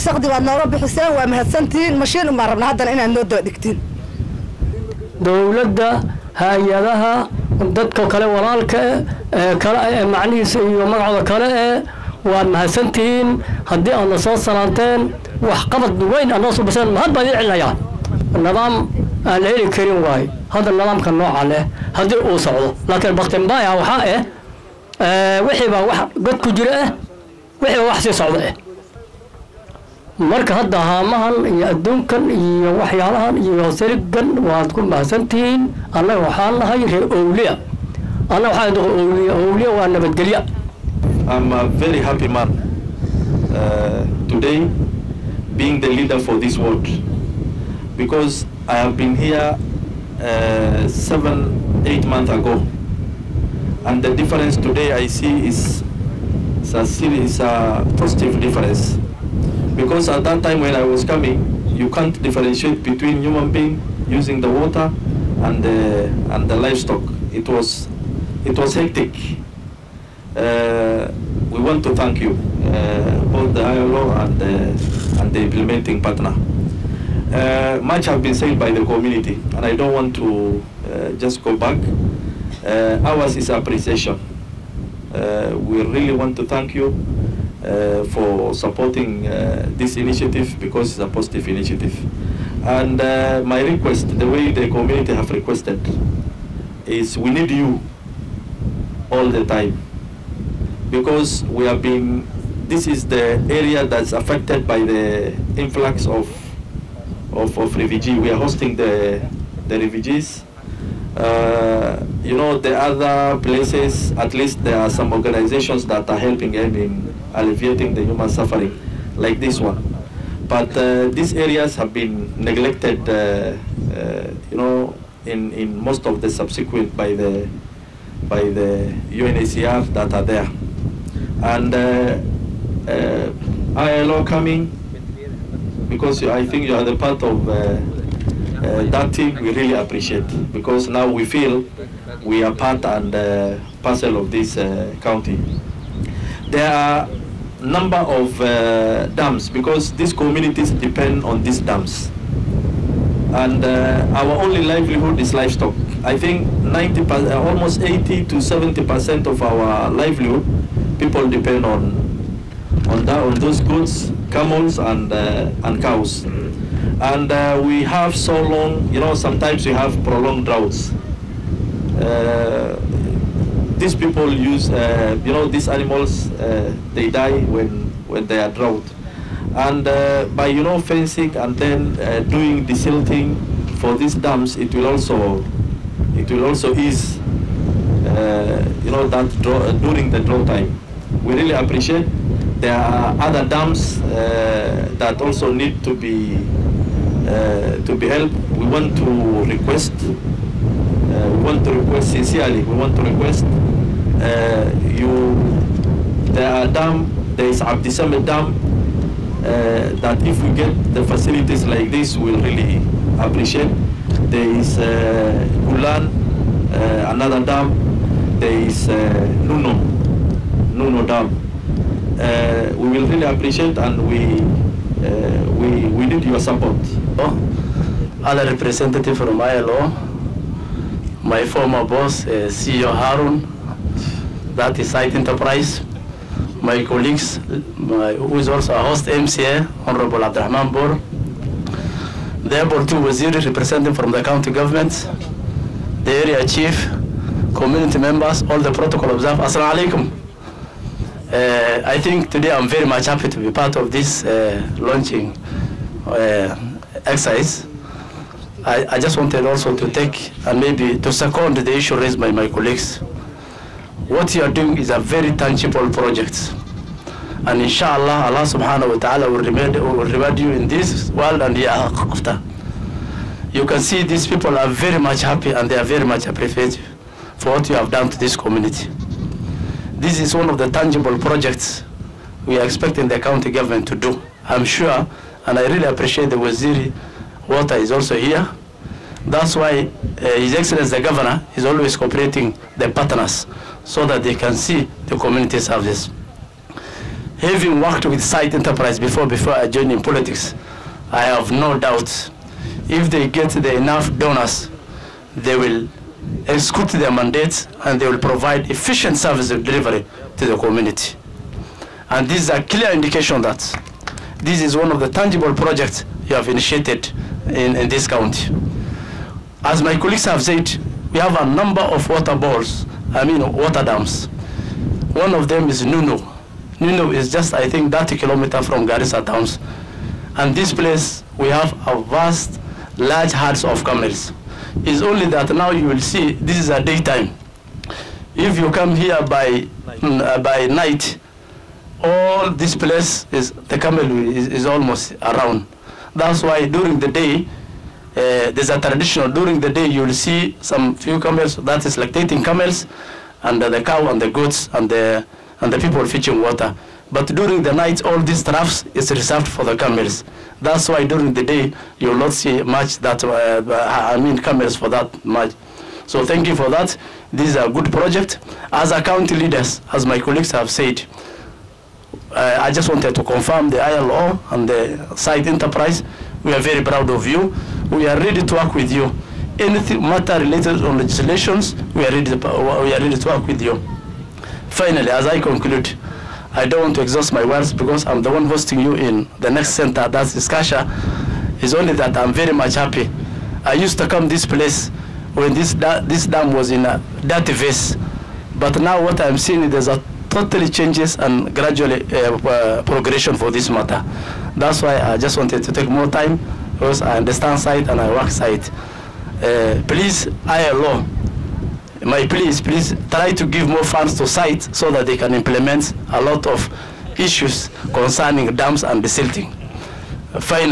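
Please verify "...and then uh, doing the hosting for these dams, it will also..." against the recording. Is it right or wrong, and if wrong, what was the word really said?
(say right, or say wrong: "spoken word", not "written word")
wrong: "silting", not "hosting".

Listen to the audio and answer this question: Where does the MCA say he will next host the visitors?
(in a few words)
Iskasha.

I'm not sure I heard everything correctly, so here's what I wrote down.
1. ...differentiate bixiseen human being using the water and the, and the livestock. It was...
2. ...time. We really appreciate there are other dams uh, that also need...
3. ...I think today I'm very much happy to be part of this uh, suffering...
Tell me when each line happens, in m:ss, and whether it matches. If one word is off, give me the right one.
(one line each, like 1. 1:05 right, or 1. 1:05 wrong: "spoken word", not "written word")
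1. 1:02 wrong: "between", not "bixiseen"
2. 3:10 right
3. 4:11 wrong: "launching", not "suffering".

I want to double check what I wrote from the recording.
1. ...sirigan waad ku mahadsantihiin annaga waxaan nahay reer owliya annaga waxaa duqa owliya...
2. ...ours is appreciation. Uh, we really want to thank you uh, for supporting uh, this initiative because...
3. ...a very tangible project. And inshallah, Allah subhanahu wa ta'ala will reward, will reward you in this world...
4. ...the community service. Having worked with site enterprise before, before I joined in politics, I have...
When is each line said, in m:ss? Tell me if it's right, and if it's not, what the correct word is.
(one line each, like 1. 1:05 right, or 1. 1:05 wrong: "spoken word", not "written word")
1. 0:33 right
2. 1:23 right
3. 4:24 right
4. 4:55 right.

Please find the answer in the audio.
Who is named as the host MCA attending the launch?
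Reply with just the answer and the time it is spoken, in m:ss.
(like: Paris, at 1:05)
Abdurrahman Bor, at 4:00.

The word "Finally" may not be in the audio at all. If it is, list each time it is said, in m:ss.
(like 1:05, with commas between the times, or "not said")
6:24.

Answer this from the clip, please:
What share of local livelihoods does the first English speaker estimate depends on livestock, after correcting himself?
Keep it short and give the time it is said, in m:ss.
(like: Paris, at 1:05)
80 to 70%, at 2:37.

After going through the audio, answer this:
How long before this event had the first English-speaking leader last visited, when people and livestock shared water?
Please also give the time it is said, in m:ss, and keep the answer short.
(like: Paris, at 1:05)
7 or 8 months, at 0:51.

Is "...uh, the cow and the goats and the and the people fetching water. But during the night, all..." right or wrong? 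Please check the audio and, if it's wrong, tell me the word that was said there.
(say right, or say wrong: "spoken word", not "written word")
right.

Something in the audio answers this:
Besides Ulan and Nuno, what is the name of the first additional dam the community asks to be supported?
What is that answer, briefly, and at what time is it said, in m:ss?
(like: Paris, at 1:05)
Abdissamit Dam, at 3:27.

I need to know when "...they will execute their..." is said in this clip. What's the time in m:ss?
5:05.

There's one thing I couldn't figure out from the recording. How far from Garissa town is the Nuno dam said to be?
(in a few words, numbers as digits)
30 kilometers.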